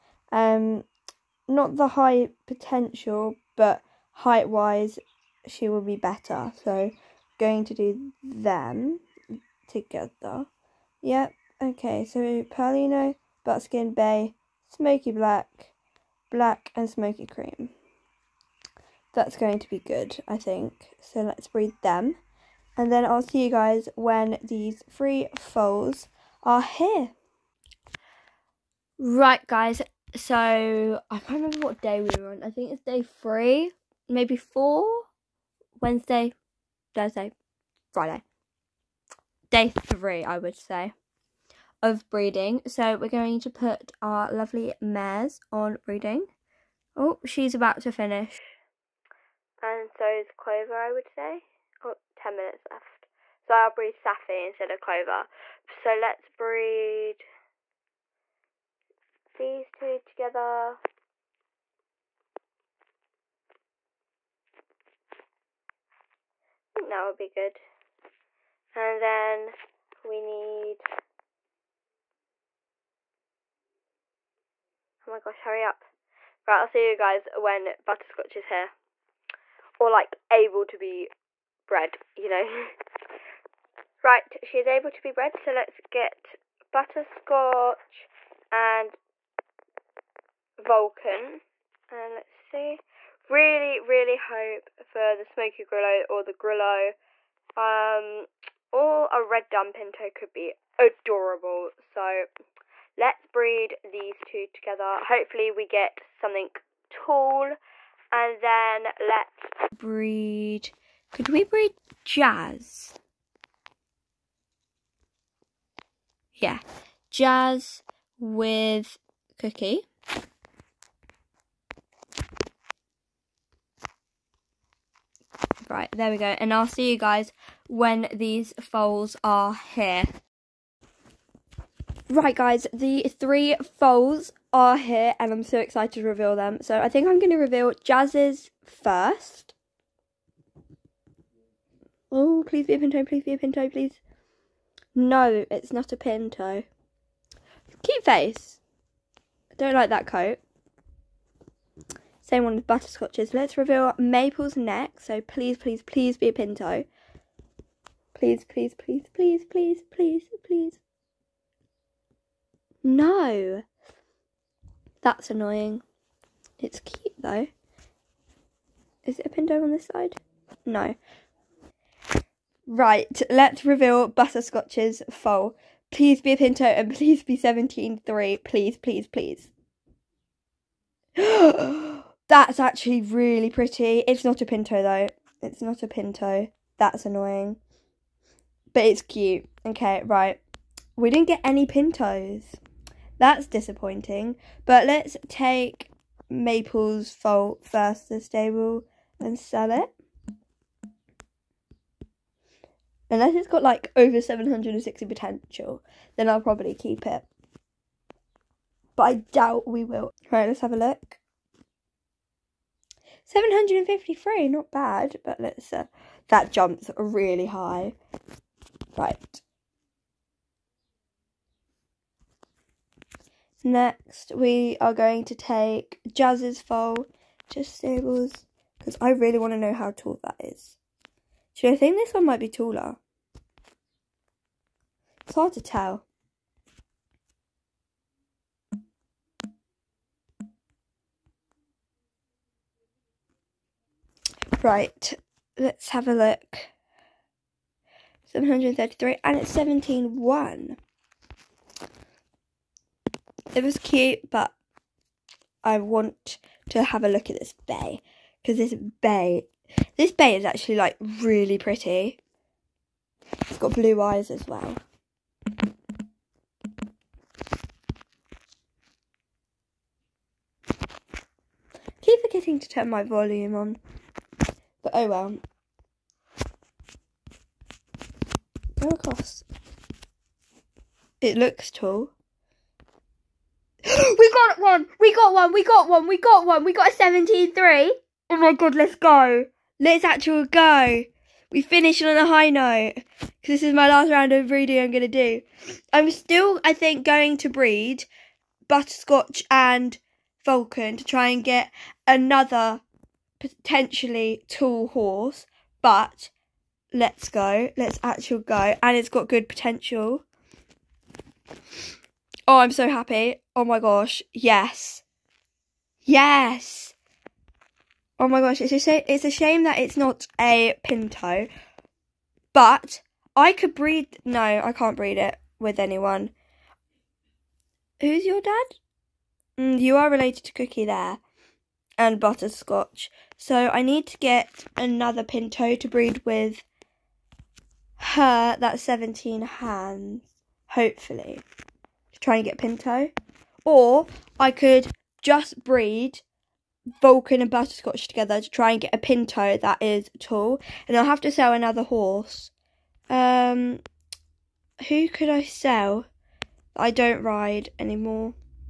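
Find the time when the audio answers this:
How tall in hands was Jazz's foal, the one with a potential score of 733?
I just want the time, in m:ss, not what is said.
4:09.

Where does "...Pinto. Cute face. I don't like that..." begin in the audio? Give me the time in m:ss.
2:25.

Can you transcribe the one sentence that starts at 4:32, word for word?
keep forgetting to turn my volume on.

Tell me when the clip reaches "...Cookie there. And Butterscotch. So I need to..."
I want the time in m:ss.
5:30.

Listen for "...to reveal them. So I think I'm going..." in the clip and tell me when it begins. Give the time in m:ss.
2:15.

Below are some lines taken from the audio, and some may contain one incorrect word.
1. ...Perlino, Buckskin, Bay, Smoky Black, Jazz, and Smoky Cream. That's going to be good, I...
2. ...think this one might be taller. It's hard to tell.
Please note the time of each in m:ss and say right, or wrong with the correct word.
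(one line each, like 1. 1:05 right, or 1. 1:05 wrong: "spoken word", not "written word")
1. 0:12 wrong: "Black", not "Jazz"
2. 3:51 right.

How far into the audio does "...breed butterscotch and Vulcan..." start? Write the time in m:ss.
4:57.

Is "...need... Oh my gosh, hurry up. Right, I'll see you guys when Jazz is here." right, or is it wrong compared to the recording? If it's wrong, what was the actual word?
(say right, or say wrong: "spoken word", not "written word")
wrong: "Butterscotch", not "Jazz".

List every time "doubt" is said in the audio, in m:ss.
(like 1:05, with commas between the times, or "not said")
3:29.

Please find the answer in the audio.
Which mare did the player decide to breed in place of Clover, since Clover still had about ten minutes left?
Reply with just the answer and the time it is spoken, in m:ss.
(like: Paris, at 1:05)
Safi, at 0:53.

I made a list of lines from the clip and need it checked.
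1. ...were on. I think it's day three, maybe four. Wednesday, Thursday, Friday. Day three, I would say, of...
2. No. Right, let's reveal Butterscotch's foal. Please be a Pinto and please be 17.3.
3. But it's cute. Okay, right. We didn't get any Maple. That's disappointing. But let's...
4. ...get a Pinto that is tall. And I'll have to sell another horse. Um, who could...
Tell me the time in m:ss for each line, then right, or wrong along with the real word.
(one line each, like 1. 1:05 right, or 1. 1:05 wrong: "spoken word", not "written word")
1. 0:32 right
2. 2:50 right
3. 3:08 wrong: "Pintos", not "Maple"
4. 5:48 right.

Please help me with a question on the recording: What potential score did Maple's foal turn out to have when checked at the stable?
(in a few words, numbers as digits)
753.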